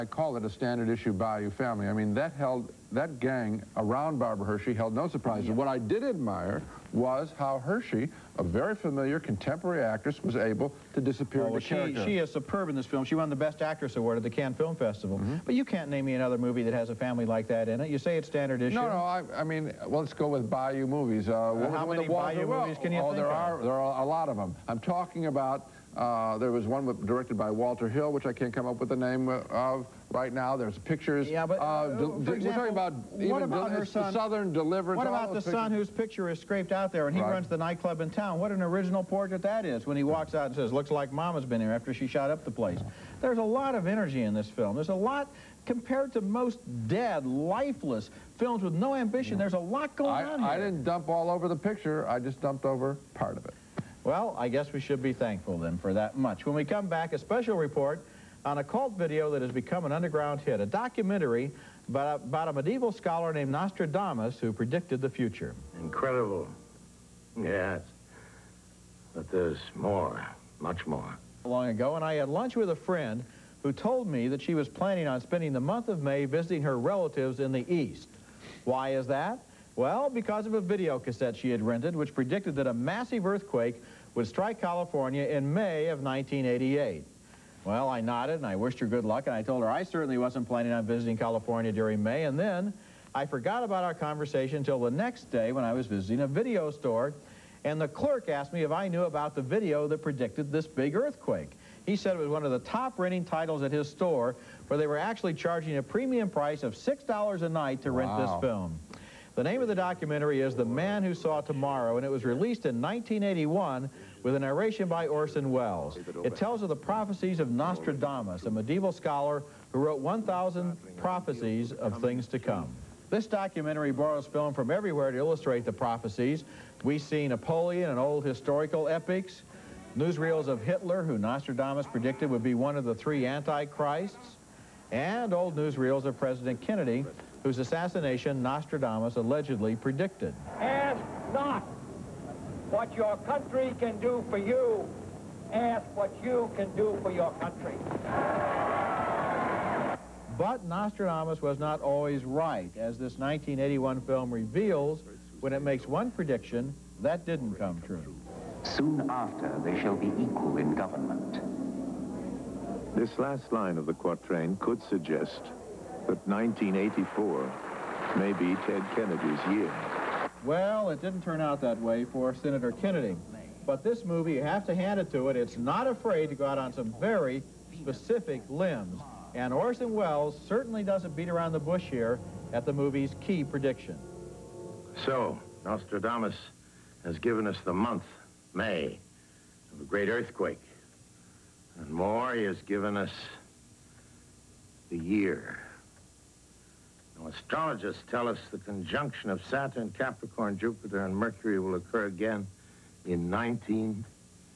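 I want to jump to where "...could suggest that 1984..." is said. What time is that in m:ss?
2:44.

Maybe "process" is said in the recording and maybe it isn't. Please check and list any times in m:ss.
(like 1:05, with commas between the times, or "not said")
not said.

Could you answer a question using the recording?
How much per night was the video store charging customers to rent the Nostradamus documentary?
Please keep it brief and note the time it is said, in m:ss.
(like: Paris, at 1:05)
$6, at 1:46.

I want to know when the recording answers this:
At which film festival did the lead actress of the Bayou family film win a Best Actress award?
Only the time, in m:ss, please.
0:14.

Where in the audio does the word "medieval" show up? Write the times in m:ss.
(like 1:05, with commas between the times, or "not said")
1:02, 1:58.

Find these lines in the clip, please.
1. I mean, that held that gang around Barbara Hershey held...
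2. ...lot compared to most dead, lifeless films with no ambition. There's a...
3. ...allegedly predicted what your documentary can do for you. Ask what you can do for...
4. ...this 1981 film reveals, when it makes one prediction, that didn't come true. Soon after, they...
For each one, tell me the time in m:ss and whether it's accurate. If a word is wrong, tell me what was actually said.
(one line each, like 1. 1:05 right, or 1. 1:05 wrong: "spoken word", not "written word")
1. 0:01 right
2. 0:44 right
3. 2:19 wrong: "country", not "documentary"
4. 2:32 right.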